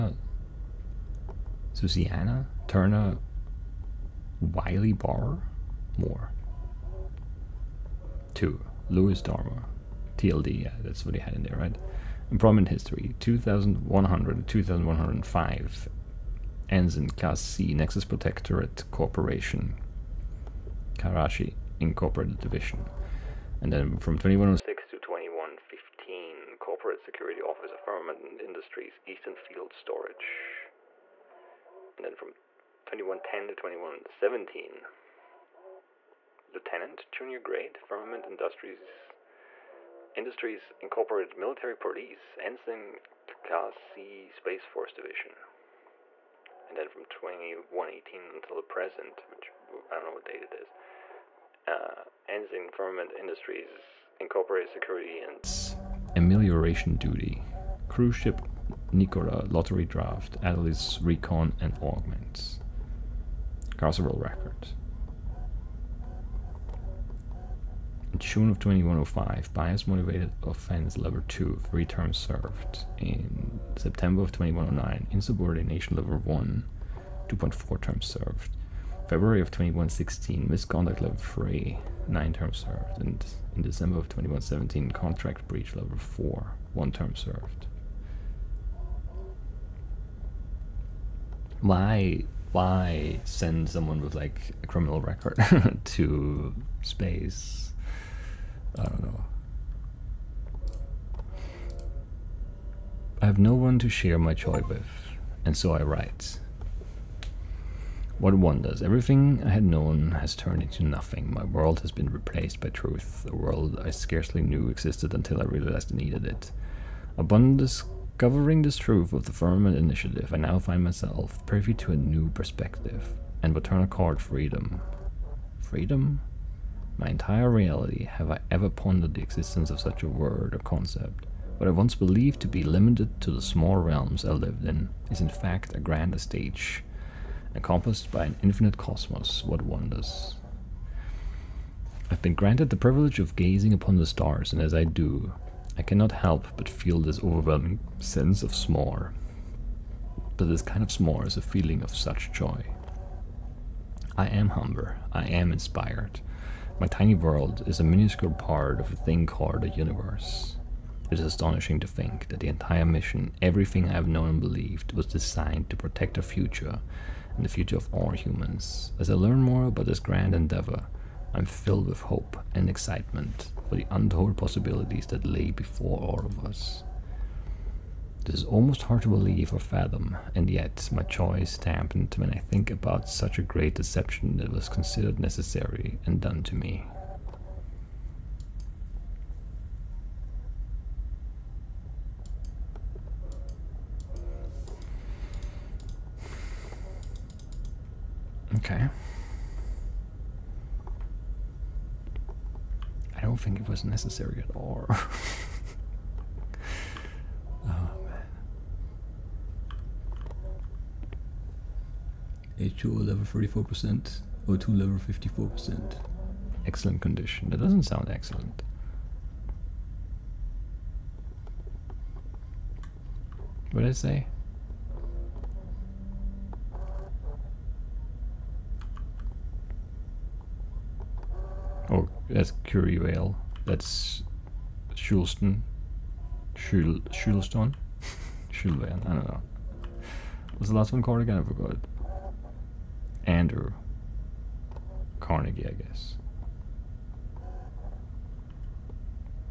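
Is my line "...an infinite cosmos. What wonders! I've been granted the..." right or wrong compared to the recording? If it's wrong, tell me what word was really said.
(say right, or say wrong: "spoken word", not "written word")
right.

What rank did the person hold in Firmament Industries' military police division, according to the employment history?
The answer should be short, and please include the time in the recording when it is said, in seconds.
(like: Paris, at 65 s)
Lieutenant, junior grade, at 36 s.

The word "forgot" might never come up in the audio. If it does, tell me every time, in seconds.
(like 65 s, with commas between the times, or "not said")
241 s.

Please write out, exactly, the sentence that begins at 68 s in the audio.
June of 2105, bias motivated offense level 2, three terms served.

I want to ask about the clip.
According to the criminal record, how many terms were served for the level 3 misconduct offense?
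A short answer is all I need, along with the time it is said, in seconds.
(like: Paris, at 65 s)
9, at 82 s.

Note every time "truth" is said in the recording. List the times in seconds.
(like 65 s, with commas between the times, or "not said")
112 s, 118 s.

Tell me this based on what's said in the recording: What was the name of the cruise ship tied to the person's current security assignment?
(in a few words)
Nicola.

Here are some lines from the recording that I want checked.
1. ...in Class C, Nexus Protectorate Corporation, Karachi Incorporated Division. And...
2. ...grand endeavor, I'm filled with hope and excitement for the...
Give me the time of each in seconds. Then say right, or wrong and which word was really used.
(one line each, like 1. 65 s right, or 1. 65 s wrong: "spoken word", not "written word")
1. 16 s right
2. 169 s right.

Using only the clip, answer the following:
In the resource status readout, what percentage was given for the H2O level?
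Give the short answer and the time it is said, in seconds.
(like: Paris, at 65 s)
34%, at 213 s.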